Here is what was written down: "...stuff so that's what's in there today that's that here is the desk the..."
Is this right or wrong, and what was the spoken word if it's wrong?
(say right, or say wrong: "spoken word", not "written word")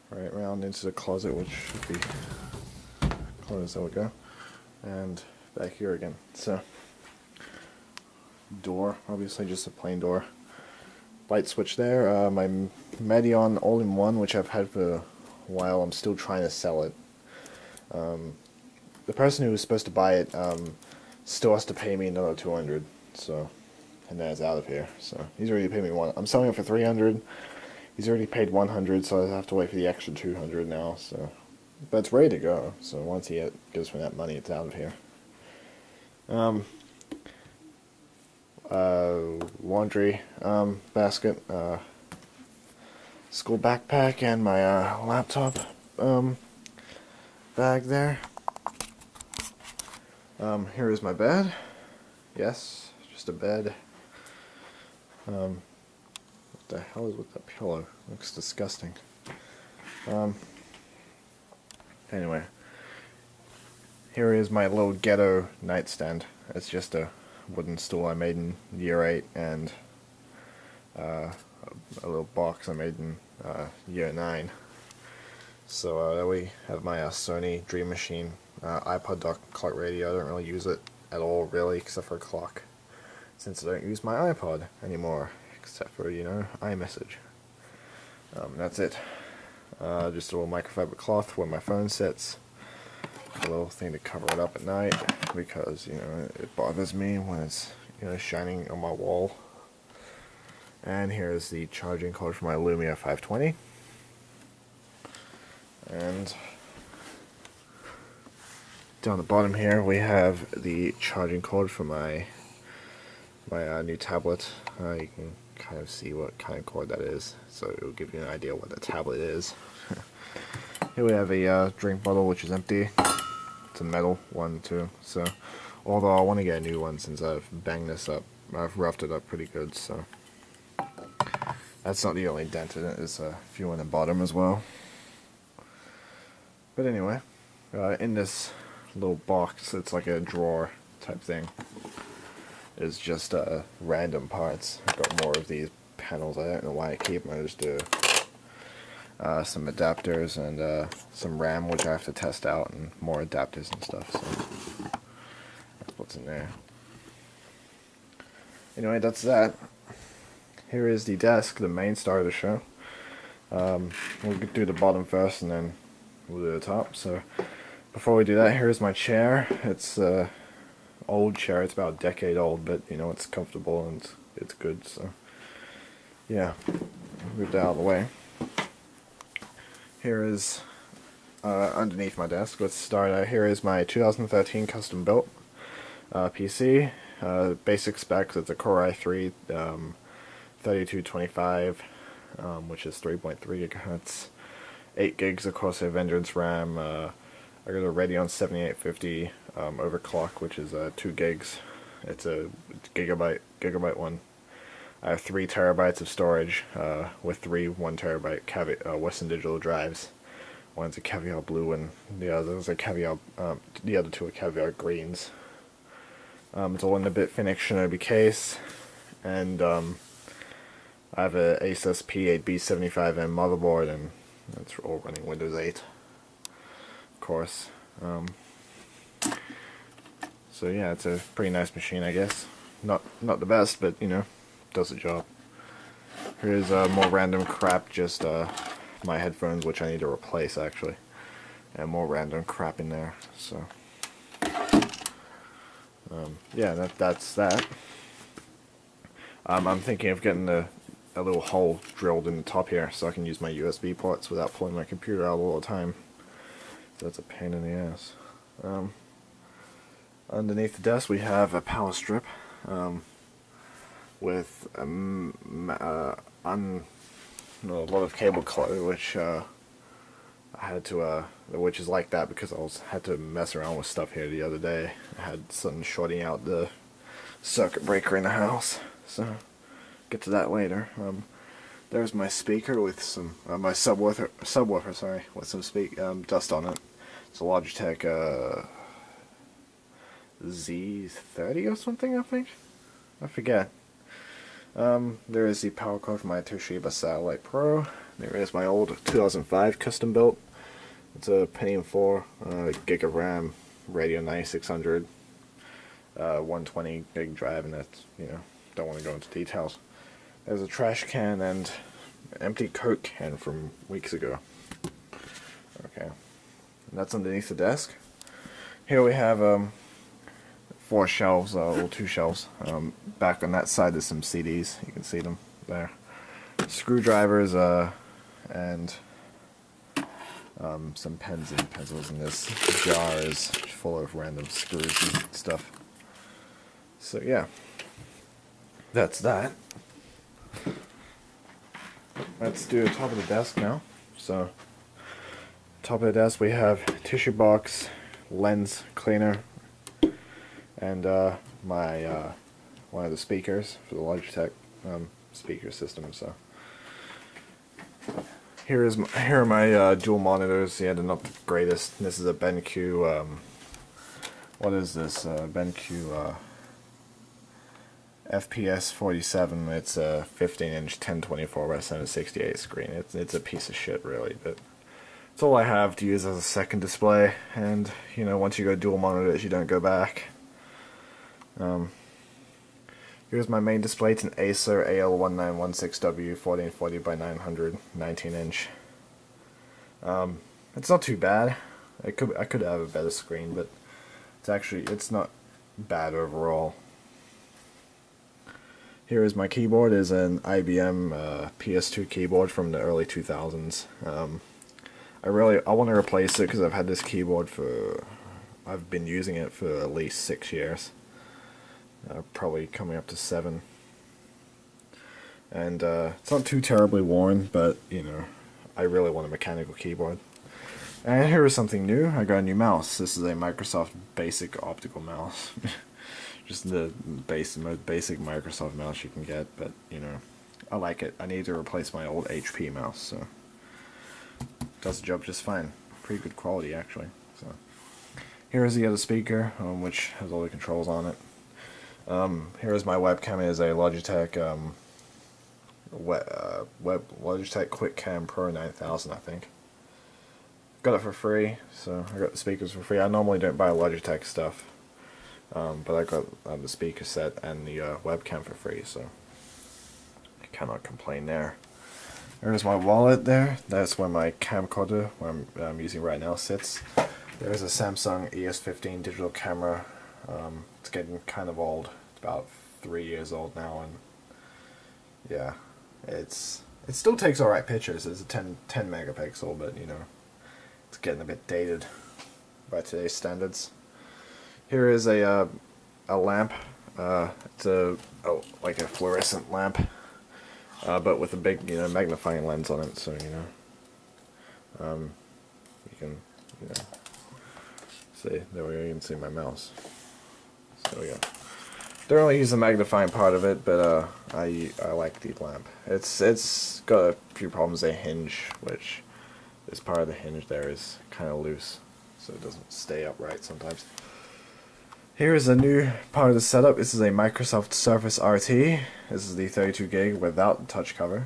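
wrong: "anyway", not "today".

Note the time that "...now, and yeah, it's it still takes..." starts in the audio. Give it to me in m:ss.
7:53.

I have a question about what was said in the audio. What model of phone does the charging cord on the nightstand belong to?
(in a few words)
Lumia 520.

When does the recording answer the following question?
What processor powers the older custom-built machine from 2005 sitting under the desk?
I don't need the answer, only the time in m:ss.
5:01.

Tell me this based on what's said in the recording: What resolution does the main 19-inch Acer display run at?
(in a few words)
1440 by 900.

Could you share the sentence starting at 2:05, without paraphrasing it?
So, although I want to get a new one since I've banged this up, I've roughed it up pretty good.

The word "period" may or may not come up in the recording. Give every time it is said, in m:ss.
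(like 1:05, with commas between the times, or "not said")
not said.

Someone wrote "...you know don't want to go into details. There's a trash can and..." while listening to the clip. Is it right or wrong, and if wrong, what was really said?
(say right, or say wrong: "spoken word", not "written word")
right.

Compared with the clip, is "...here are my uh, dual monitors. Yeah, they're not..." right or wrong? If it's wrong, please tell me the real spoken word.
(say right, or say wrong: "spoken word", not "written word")
right.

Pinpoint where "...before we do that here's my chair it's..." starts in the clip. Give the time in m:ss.
2:47.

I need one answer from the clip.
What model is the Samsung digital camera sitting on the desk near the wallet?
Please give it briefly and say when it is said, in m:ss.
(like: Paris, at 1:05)
ES15, at 7:48.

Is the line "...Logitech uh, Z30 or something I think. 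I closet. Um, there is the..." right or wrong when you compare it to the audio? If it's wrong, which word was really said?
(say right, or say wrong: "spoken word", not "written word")
wrong: "forget", not "closet".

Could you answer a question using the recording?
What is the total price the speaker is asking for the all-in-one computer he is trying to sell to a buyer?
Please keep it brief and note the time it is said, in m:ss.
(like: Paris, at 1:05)
300, at 0:26.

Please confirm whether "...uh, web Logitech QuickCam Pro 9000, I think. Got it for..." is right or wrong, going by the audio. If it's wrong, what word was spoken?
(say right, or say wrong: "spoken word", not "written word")
right.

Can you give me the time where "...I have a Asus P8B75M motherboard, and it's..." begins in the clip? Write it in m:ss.
3:41.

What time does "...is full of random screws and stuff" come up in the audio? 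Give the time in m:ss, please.
5:33.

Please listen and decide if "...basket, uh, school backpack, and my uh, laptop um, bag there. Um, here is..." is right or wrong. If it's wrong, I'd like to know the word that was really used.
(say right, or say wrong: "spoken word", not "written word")
right.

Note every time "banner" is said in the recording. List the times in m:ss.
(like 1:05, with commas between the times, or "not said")
not said.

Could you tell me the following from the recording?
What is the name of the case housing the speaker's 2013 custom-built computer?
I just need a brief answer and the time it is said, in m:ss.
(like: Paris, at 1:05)
BitFenix Shinobi, at 3:37.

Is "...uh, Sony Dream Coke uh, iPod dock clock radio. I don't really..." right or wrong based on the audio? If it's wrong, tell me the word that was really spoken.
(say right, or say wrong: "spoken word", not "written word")
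wrong: "Machine", not "Coke".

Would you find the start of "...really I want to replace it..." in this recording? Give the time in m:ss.
6:45.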